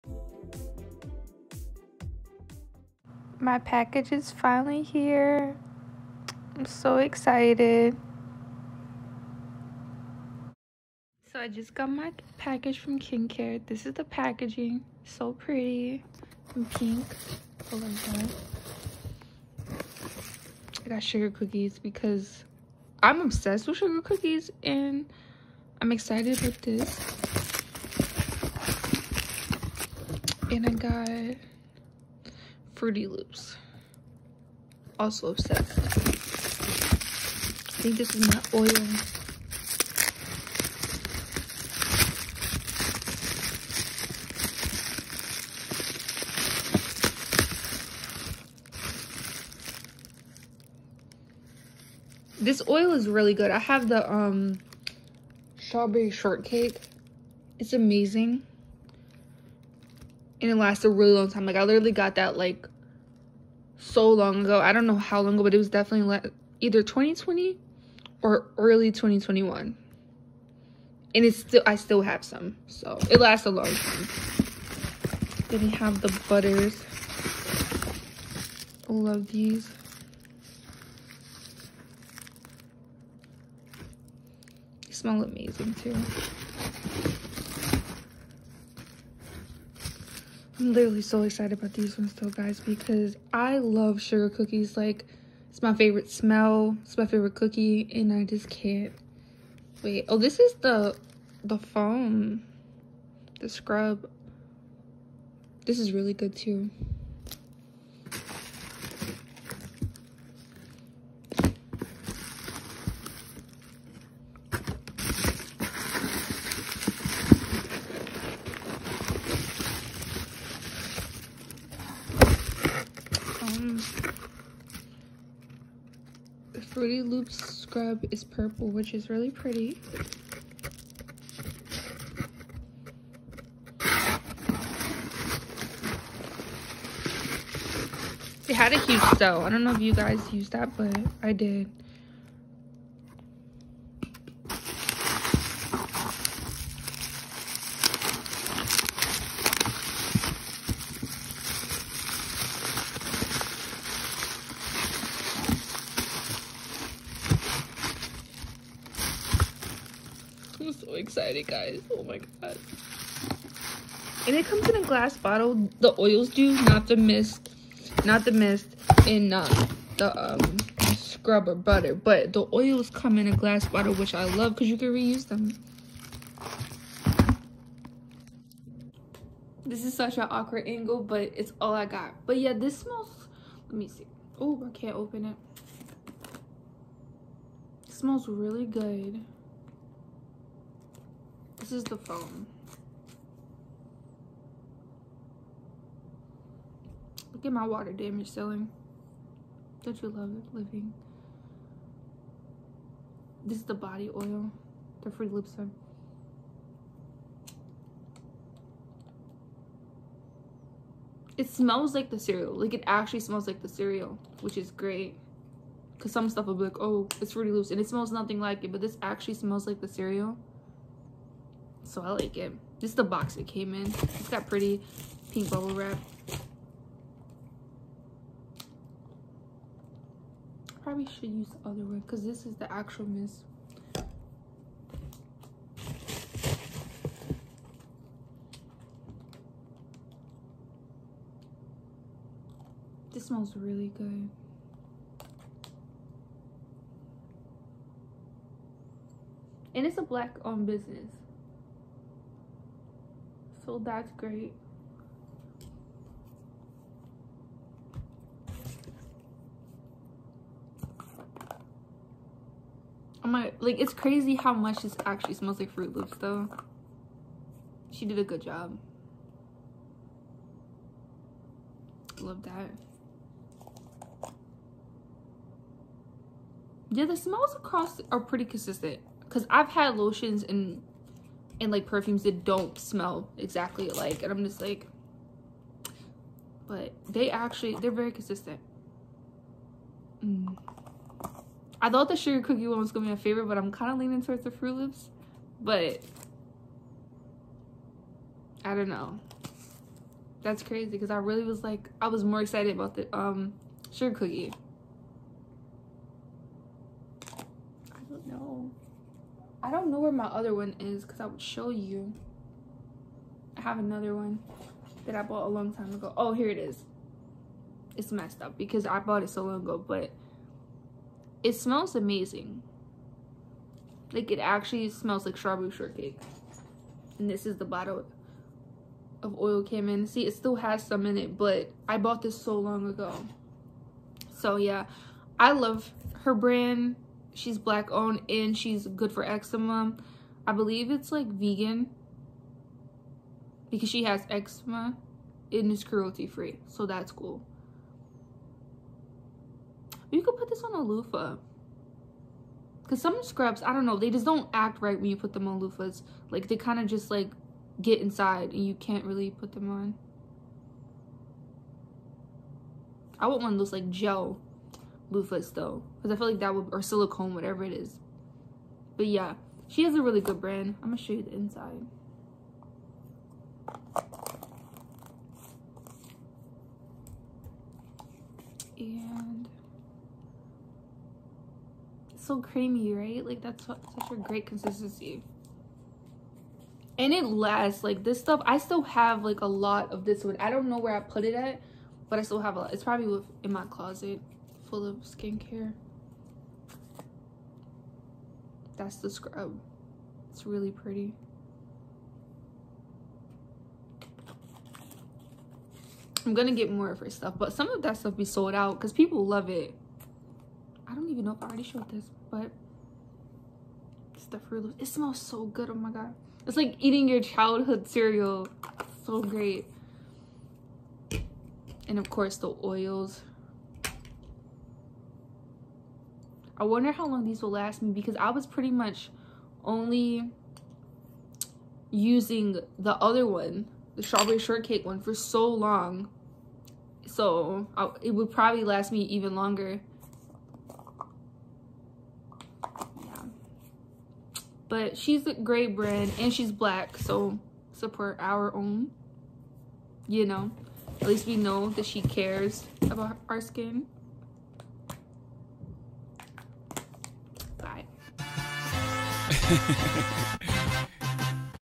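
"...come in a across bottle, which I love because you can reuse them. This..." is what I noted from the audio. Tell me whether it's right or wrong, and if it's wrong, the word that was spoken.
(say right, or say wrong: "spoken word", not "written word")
wrong: "glass", not "across".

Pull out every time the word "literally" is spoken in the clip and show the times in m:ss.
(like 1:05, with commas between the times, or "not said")
1:01, 1:30.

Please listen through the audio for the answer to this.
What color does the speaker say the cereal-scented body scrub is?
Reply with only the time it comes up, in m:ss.
2:08.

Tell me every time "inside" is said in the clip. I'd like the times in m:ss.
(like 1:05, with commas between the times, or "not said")
5:58, 6:11.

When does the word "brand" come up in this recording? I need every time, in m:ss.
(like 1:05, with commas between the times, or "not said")
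5:36, 6:10, 7:25.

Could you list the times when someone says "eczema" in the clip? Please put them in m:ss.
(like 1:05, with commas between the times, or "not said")
5:39, 5:44.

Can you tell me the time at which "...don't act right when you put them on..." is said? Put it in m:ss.
5:54.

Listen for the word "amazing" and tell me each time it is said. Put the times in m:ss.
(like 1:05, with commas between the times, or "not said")
0:57, 1:25, 5:21.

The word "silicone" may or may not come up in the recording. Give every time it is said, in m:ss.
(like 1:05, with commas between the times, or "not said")
6:06.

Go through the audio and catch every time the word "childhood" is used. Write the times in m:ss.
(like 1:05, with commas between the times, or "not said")
6:57.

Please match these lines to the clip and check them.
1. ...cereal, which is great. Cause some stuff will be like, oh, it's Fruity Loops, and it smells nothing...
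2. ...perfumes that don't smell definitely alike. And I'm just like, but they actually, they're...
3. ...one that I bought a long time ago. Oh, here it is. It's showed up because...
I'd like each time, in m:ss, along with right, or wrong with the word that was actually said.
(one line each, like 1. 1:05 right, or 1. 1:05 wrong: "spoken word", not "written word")
1. 3:33 right
2. 4:41 wrong: "exactly", not "definitely"
3. 5:14 wrong: "messed", not "showed".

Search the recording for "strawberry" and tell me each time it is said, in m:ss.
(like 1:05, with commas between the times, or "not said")
0:55, 5:25, 7:14.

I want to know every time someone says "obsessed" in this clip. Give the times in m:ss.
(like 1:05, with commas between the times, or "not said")
0:23, 0:35.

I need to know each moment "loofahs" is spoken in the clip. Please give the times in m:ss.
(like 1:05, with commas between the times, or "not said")
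5:50, 5:55, 6:05.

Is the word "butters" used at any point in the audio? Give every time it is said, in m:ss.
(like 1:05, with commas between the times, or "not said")
1:16, 2:51.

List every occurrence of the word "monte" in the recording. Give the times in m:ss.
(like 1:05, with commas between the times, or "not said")
not said.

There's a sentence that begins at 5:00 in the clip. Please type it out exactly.
That's crazy because I really was like, I was more excited about the um, sugar cookie.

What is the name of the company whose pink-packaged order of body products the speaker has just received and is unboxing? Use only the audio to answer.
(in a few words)
Kyncare.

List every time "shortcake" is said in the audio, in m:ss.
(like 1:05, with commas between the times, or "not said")
0:56, 5:25, 7:14.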